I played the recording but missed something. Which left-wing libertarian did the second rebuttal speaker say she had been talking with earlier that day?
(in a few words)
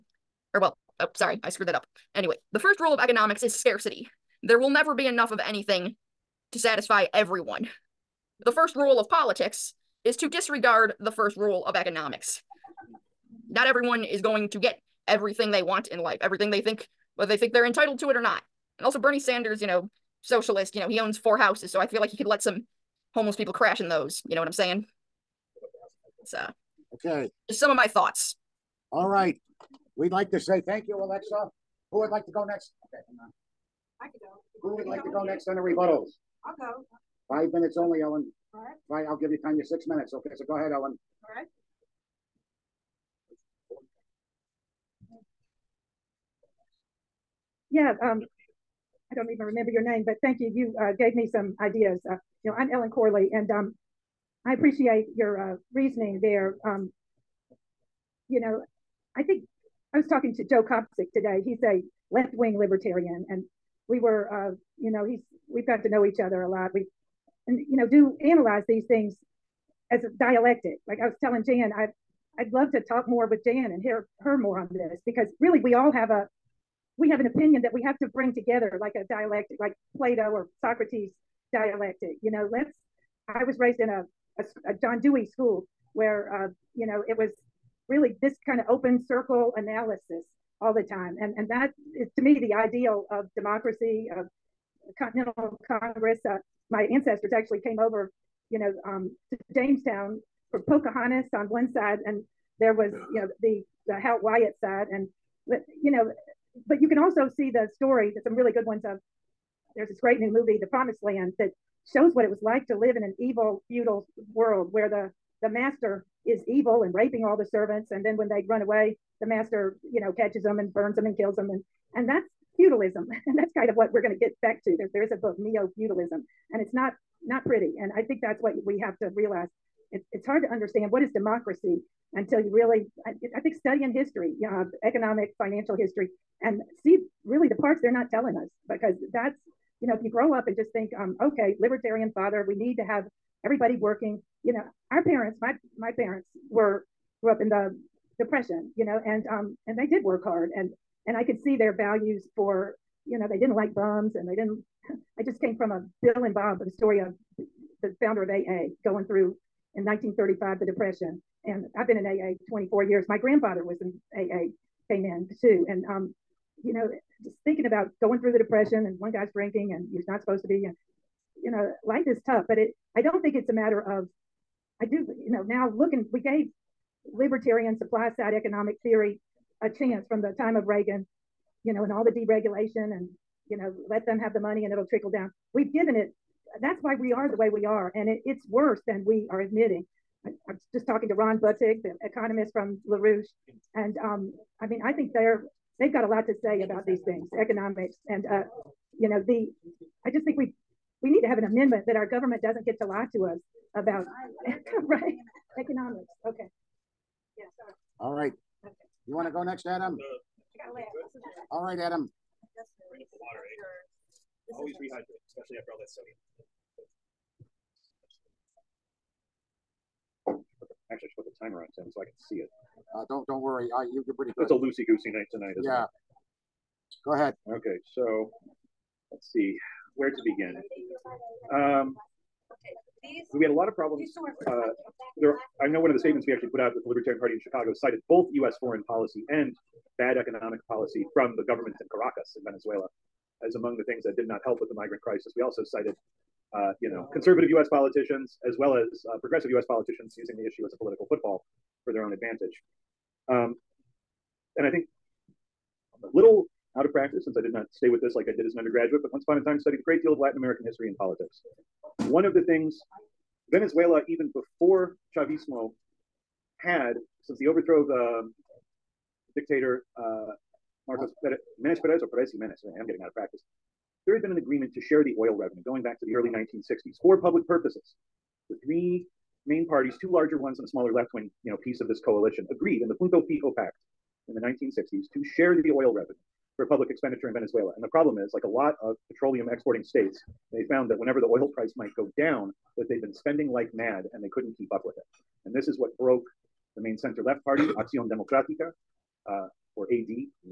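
Joe Kopsik.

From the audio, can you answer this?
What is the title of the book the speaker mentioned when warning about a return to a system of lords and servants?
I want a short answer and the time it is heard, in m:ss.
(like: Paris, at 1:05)
Neo Feudalism, at 2:05.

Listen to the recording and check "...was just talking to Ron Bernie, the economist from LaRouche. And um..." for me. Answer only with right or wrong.
wrong.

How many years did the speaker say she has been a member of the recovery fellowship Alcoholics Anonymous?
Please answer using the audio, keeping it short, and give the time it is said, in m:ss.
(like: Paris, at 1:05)
24, at 2:42.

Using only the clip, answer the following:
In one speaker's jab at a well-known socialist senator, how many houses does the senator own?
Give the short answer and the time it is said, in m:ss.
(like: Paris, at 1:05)
4, at 0:21.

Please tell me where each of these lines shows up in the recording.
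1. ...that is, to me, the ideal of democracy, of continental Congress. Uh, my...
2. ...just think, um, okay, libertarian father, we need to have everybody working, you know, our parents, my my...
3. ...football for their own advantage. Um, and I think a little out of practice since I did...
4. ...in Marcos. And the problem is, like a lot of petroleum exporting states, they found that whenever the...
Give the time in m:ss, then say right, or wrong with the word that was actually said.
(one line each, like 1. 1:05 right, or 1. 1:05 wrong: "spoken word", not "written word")
1. 1:31 right
2. 2:20 right
3. 4:11 right
4. 4:47 wrong: "Venezuela", not "Marcos".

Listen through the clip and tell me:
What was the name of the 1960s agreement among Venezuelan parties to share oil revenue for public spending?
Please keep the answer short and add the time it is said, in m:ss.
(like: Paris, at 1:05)
Punto Fijo Pact, at 4:43.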